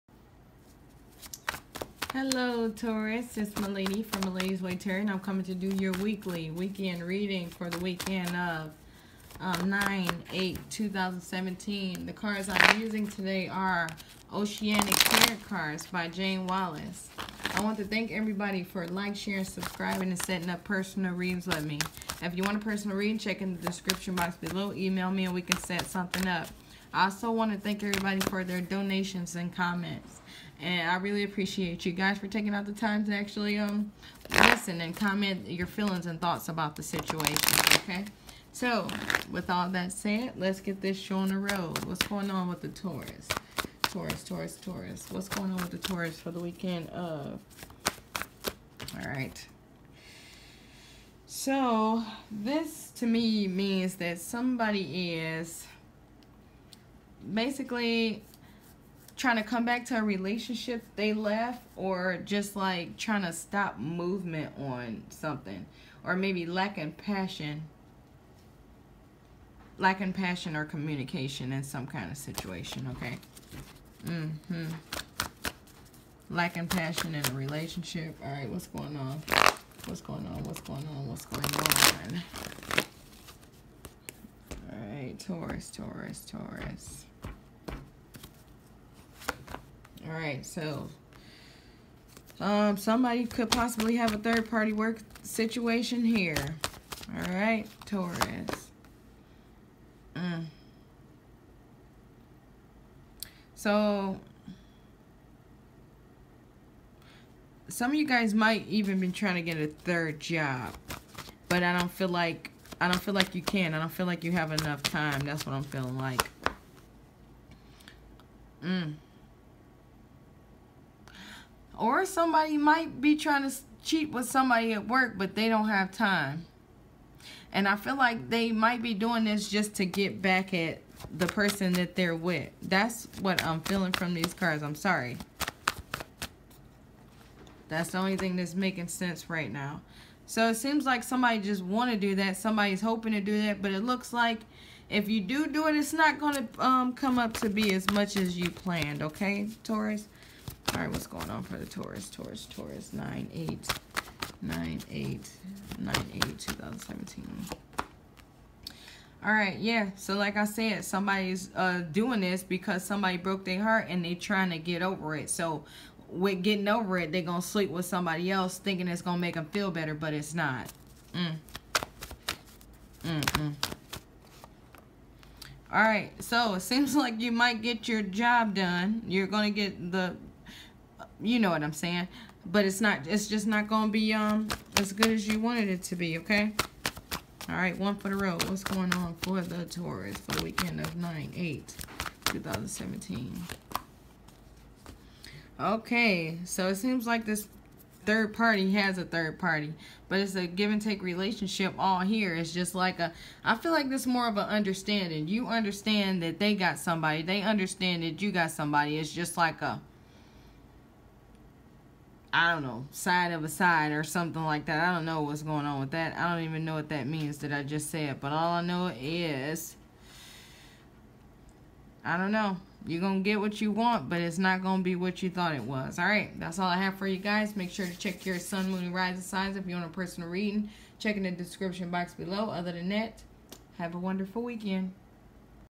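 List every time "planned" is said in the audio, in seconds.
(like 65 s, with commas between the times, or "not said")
148 s.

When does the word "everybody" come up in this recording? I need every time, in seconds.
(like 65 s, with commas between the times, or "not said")
18 s, 27 s.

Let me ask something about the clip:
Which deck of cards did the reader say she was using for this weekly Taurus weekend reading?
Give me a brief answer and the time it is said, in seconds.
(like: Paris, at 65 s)
Oceanic Tarot, at 14 s.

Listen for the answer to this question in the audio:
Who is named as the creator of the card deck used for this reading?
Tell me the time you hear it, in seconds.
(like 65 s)
16 s.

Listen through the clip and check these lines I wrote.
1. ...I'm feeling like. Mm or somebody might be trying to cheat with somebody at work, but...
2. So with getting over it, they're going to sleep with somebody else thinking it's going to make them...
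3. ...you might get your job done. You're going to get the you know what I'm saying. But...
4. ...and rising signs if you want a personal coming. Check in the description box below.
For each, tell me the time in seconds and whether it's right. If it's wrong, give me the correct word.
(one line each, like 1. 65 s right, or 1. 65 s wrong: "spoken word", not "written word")
1. 115 s right
2. 165 s right
3. 177 s right
4. 228 s wrong: "reading", not "coming".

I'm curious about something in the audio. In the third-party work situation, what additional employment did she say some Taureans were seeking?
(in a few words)
third job.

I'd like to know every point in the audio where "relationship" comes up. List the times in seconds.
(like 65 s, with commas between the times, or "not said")
60 s, 77 s, 201 s.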